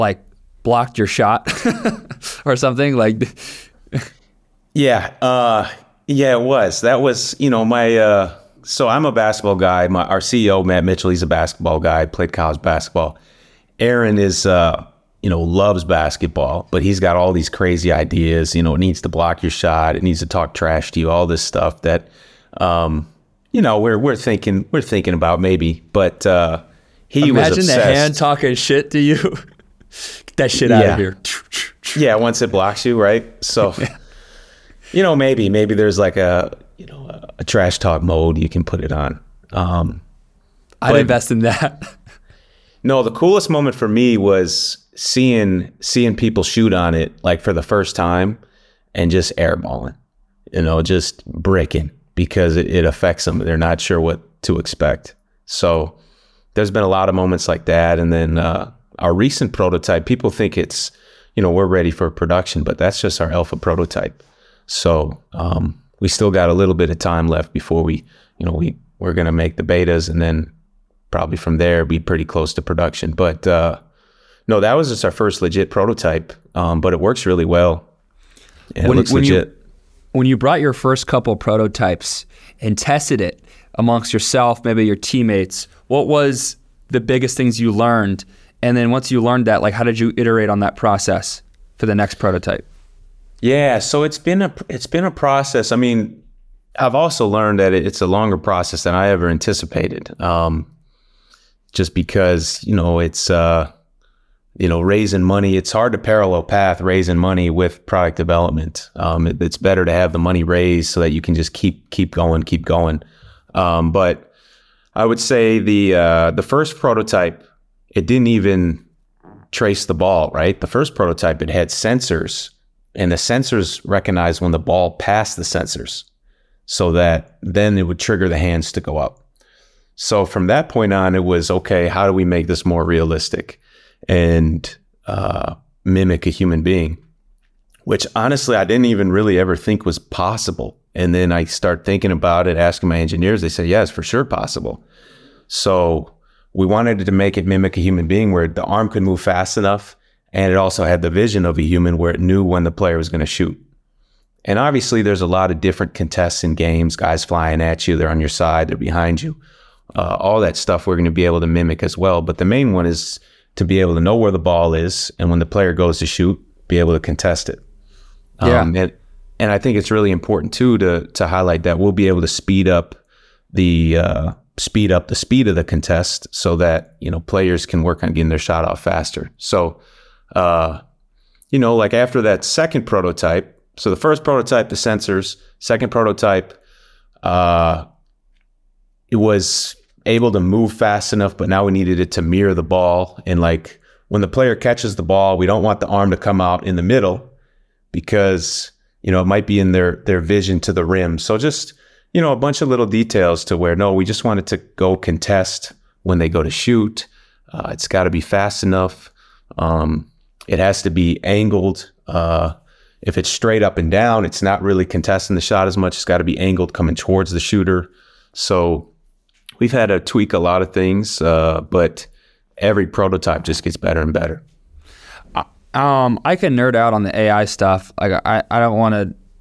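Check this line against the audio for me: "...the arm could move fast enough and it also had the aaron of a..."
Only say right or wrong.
wrong.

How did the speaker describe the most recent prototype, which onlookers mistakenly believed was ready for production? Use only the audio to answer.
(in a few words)
alpha prototype.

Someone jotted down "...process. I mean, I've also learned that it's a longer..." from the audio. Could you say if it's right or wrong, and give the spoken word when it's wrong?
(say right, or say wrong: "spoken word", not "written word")
right.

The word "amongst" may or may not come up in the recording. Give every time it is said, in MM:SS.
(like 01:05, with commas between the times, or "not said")
01:23.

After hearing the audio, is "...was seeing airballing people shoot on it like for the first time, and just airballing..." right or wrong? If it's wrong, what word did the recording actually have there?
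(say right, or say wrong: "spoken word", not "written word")
wrong: "seeing", not "airballing".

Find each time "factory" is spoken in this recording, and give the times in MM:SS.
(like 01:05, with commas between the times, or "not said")
not said.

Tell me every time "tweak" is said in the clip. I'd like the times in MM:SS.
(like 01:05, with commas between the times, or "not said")
03:39.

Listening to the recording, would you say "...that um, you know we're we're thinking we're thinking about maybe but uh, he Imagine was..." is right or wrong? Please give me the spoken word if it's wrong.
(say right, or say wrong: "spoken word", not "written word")
right.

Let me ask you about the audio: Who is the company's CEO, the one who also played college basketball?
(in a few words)
Matt Mitchell.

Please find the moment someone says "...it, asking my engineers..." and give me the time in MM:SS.
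02:22.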